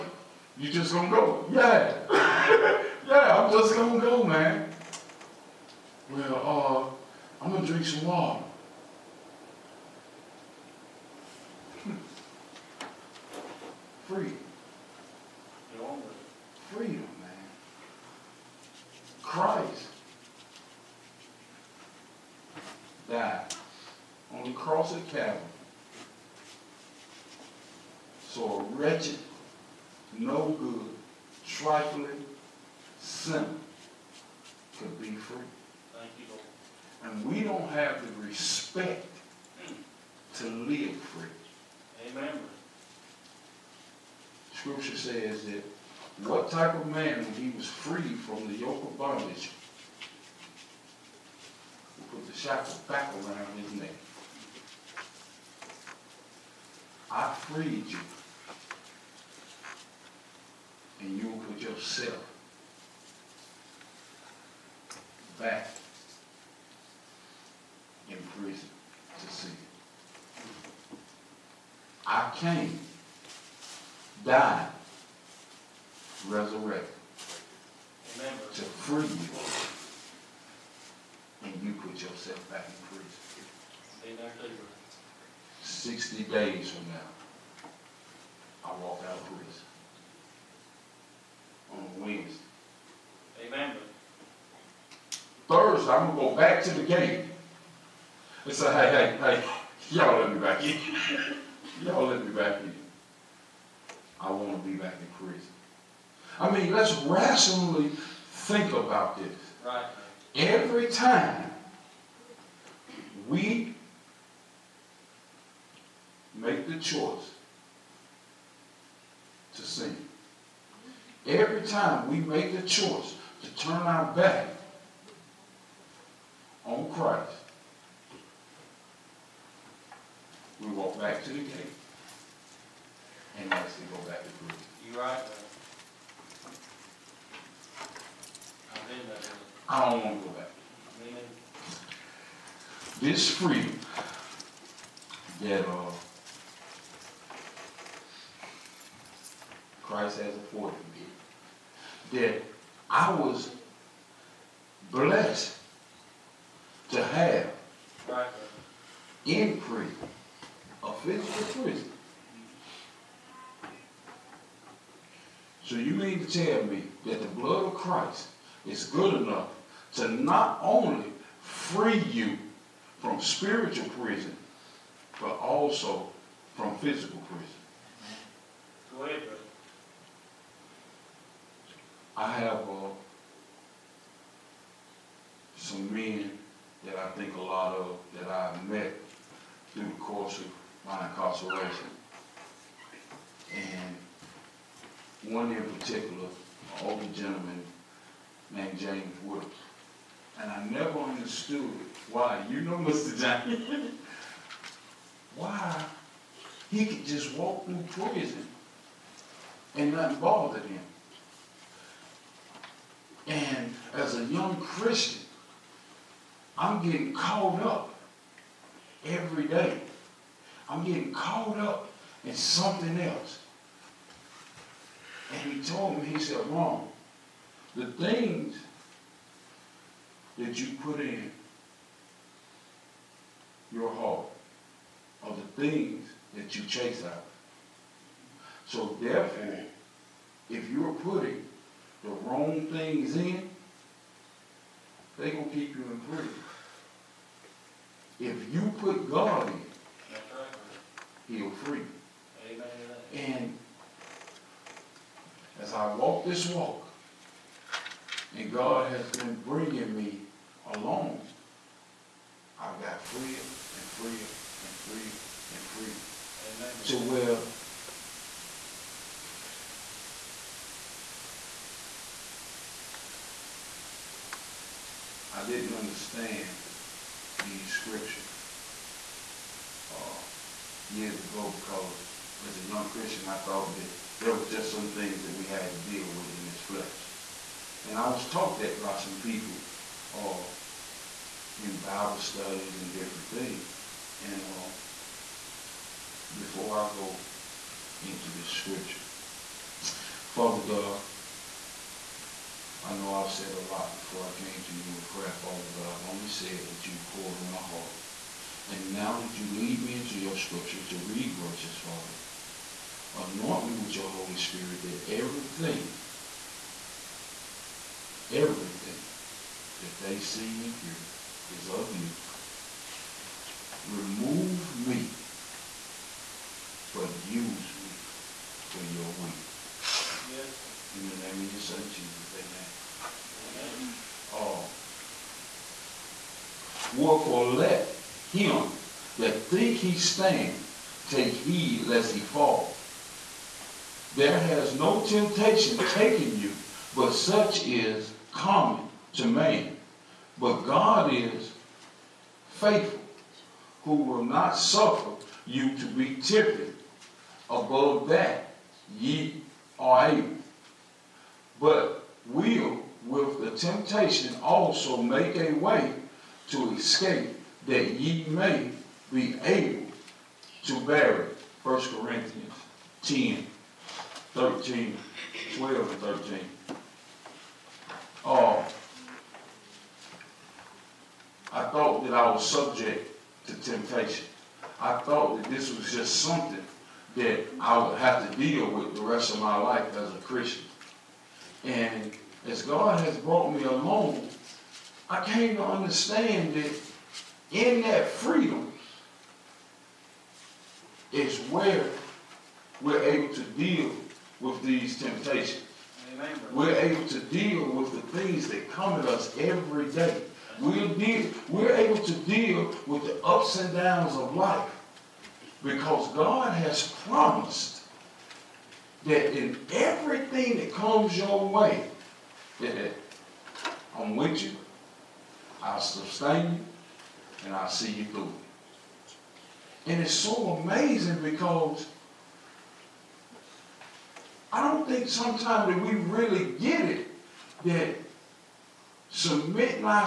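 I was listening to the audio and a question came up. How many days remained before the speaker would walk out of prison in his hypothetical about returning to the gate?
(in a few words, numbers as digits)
60.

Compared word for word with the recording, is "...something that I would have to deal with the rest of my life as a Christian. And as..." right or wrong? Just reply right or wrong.
right.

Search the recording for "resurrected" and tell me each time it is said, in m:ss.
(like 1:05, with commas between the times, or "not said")
1:16.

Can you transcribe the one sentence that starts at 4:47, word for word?
And I was taught that by some people uh, in Bible studies and different things.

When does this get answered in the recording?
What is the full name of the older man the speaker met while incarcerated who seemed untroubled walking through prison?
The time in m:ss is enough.
3:18.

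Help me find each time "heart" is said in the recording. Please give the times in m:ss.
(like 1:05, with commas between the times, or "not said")
3:53, 5:07.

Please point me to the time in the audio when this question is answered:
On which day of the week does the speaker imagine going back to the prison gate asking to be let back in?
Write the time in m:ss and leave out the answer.
1:35.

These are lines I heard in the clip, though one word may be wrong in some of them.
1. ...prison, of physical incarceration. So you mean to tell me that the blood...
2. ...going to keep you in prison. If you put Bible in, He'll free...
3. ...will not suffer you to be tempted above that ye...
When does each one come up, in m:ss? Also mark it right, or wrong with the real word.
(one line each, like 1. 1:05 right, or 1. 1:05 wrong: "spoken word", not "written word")
1. 2:39 wrong: "prison", not "incarceration"
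2. 4:05 wrong: "God", not "Bible"
3. 5:53 right.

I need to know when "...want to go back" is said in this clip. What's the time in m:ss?
2:20.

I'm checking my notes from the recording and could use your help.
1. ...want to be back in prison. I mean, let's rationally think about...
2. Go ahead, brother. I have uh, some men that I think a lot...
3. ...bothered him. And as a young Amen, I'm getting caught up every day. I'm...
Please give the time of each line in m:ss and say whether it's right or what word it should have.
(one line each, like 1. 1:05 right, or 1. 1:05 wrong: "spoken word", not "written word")
1. 1:44 right
2. 2:58 right
3. 3:30 wrong: "Christian", not "Amen".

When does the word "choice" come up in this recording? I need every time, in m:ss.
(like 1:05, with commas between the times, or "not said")
1:56, 2:02.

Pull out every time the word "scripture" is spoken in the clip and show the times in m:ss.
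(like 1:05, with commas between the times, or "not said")
0:44, 4:37, 4:58, 5:10.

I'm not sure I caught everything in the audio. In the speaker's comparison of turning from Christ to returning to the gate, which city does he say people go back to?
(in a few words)
Jerusalem.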